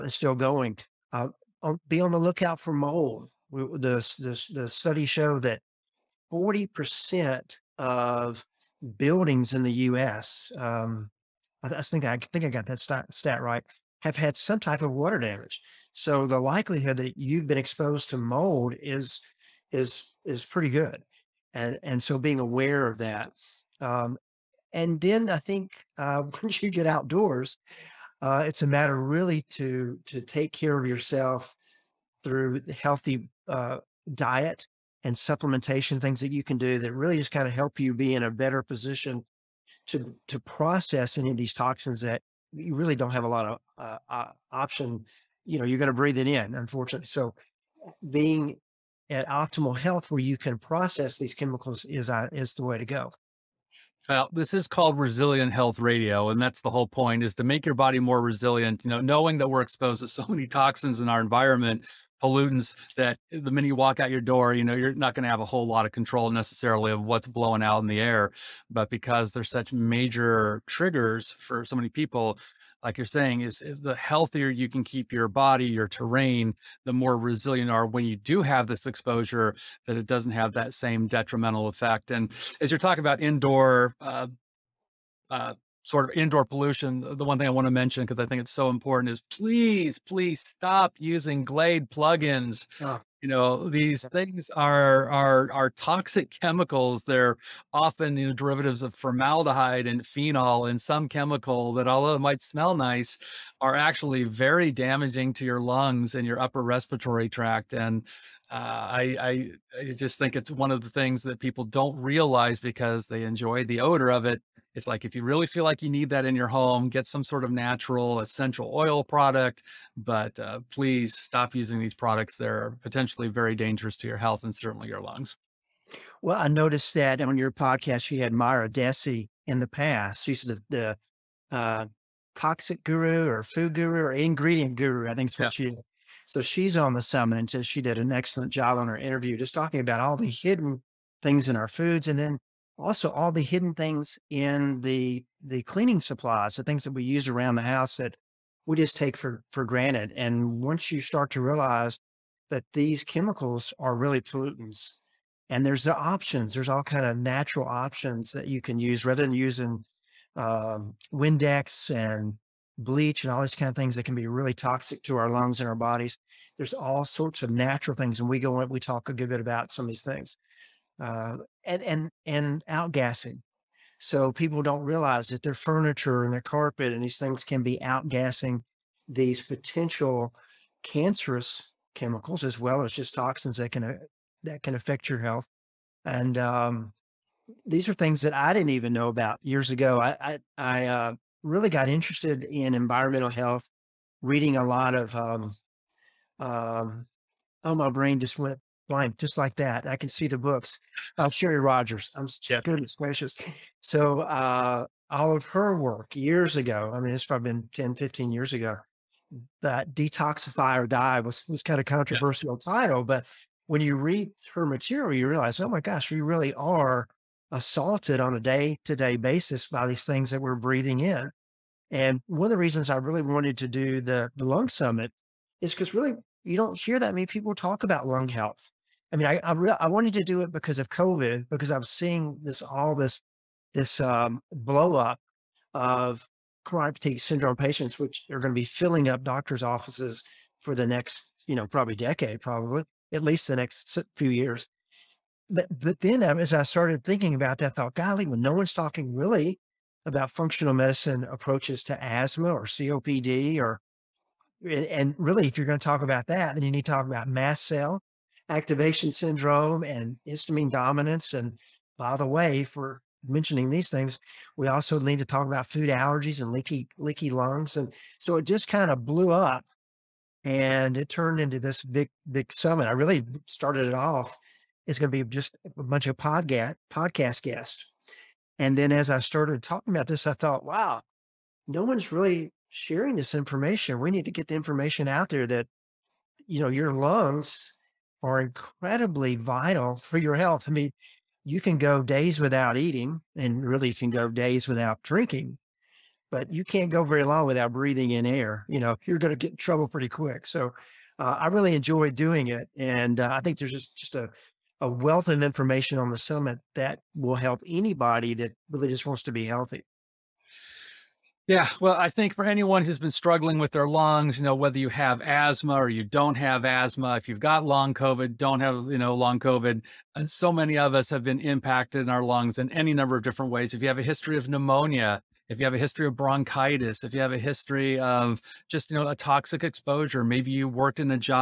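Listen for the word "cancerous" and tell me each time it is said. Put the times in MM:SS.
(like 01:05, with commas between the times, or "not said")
03:00.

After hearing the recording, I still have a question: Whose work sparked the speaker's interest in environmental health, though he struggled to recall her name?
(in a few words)
Sherry Rogers.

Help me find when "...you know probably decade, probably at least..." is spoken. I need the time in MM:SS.
04:01.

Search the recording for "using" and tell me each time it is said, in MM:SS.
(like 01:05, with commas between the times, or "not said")
01:30, 02:01, 02:39.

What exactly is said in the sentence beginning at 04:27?
And so it just kind of blew up and it turned into this big, big summit.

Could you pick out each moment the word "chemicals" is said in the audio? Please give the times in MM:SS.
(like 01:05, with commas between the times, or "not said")
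00:51, 01:36, 01:41, 02:33, 03:01.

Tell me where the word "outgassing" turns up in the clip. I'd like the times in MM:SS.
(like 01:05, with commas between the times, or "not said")
02:52, 02:57.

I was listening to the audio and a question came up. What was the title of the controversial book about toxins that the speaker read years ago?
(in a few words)
Detoxify or Die.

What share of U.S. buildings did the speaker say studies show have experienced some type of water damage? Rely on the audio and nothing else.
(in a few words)
40%.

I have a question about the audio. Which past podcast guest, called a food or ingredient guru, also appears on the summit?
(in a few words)
Mira Dessy.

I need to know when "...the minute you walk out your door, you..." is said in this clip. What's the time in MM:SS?
01:03.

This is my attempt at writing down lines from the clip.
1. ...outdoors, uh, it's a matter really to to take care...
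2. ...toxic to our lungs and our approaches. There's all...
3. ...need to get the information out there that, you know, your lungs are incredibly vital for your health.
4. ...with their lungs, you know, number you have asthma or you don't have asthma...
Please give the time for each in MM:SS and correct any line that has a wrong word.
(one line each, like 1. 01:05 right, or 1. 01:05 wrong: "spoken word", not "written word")
1. 00:26 right
2. 02:44 wrong: "bodies", not "approaches"
3. 04:44 right
4. 05:13 wrong: "whether", not "number".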